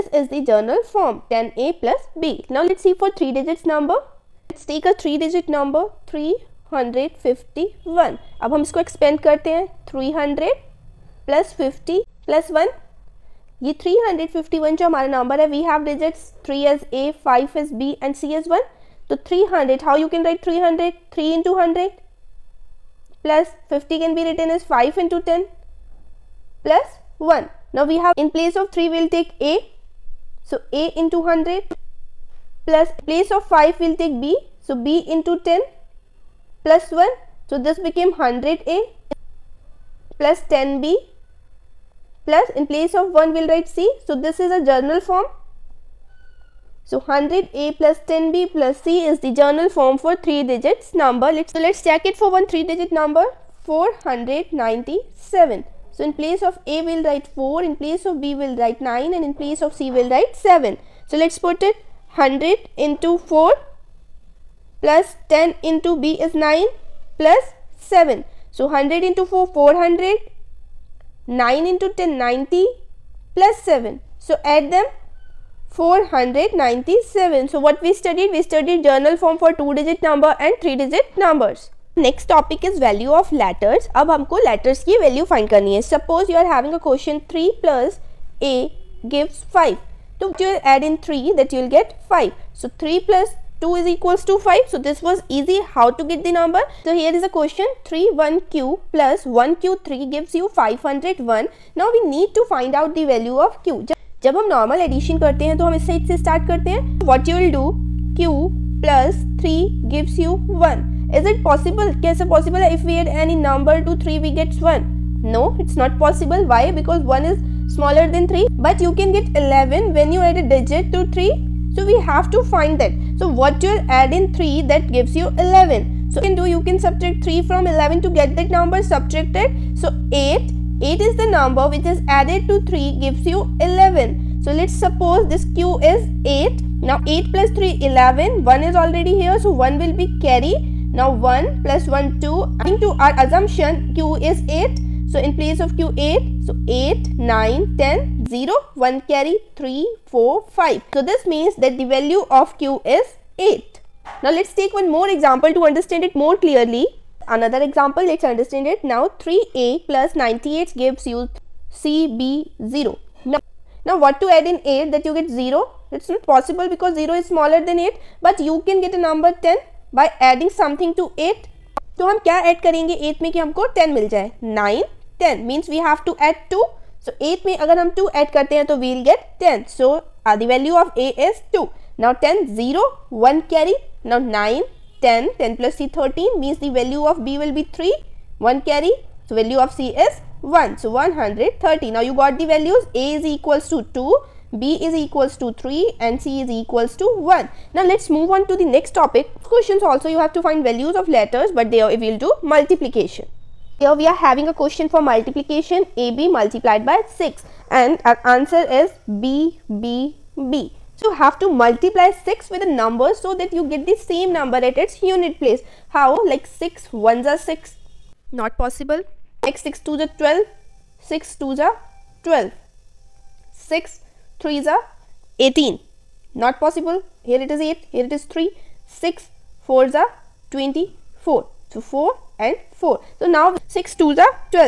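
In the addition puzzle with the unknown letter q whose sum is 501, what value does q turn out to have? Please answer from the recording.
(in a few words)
8.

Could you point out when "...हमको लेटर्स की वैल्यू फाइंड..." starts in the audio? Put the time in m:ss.
1:24.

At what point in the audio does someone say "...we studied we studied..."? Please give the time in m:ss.
1:17.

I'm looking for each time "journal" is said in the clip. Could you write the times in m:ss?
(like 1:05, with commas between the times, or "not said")
0:00, 0:44, 0:49, 1:18.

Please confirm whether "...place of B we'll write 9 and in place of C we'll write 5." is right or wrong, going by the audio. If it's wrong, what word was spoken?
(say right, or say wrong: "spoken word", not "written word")
wrong: "7", not "5".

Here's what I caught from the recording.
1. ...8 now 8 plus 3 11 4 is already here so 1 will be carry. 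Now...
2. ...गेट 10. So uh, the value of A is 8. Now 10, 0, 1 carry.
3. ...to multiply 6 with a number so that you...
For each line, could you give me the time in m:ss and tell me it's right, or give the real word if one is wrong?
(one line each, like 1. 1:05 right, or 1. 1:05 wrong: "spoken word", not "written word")
1. 2:16 wrong: "1", not "4"
2. 2:59 wrong: "2", not "8"
3. 3:31 right.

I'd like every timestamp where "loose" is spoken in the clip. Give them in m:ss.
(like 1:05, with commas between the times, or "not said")
not said.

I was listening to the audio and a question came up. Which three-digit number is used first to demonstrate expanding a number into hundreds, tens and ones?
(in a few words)
351.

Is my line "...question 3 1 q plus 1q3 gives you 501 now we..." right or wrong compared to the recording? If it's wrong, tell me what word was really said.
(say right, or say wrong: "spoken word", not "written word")
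right.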